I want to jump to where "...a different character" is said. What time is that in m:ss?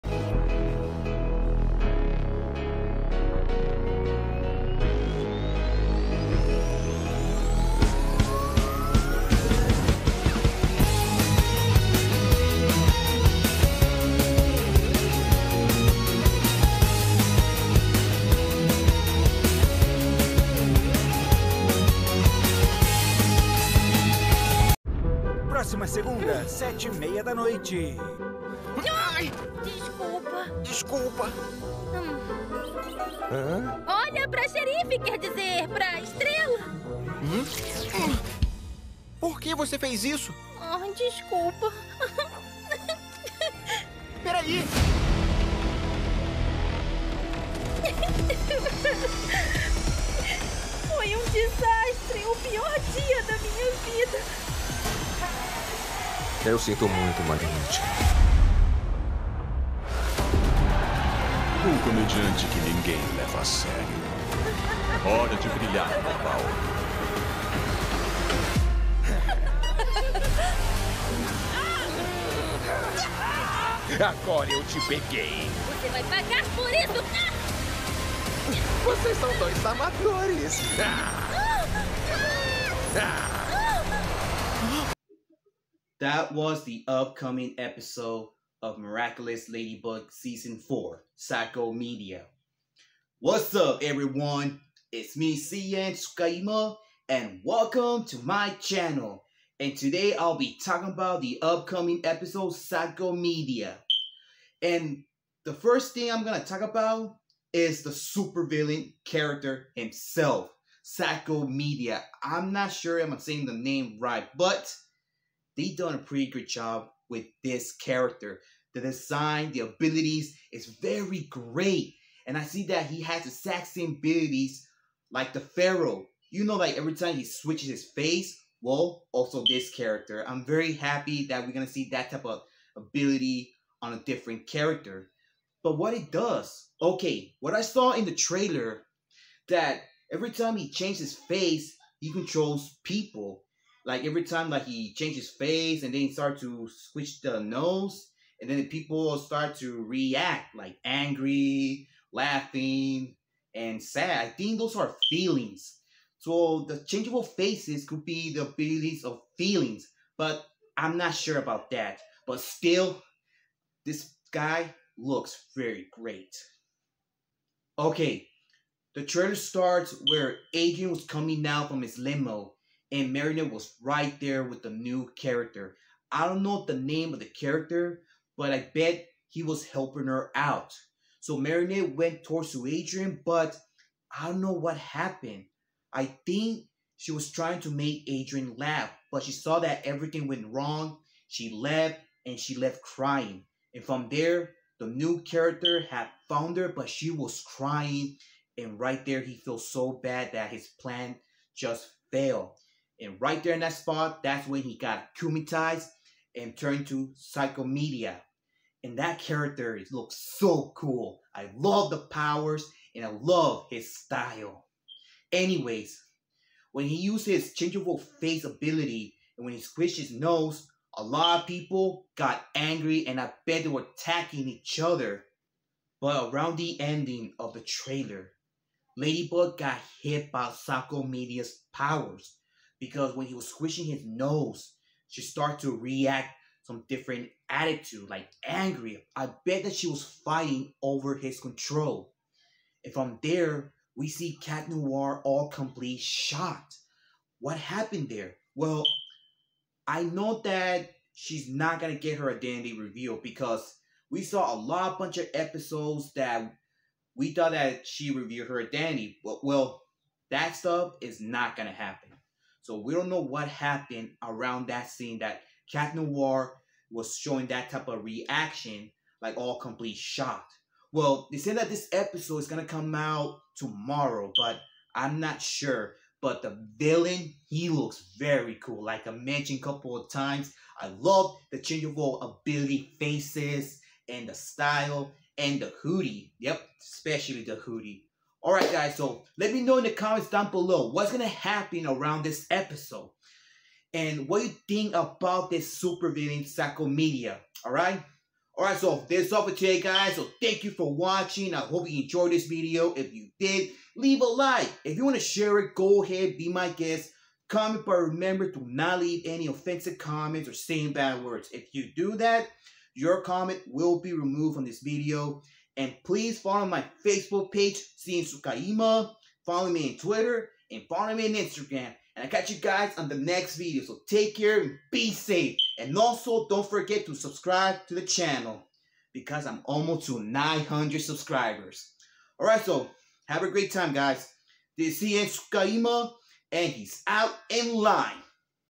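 2:13.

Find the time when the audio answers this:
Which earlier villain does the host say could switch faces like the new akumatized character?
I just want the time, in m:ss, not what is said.
2:05.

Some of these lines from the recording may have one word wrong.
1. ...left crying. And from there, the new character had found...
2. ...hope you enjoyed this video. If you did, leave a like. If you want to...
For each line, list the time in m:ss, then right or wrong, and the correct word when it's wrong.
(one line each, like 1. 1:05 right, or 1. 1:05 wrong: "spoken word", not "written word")
1. 3:12 right
2. 5:01 right.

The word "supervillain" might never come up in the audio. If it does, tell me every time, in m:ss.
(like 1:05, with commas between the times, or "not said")
1:47, 4:55.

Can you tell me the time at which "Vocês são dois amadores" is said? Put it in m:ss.
1:18.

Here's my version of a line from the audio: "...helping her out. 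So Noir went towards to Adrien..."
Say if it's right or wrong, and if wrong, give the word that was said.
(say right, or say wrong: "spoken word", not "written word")
wrong: "Marinette", not "Noir".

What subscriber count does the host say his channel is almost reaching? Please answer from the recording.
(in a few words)
900.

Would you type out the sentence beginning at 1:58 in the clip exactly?
The design, the abilities is very great.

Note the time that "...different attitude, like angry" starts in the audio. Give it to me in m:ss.
3:56.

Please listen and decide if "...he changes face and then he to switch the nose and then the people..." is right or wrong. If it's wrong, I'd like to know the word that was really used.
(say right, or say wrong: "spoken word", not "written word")
right.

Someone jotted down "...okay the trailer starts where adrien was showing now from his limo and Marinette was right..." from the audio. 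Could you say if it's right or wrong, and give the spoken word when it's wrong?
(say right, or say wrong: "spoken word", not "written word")
wrong: "coming", not "showing".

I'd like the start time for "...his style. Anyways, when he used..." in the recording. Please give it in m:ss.
3:33.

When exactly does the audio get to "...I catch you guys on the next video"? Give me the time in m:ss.
5:22.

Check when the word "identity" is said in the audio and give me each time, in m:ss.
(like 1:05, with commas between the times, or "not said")
4:12, 4:18.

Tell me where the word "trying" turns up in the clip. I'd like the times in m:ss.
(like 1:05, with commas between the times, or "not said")
3:07.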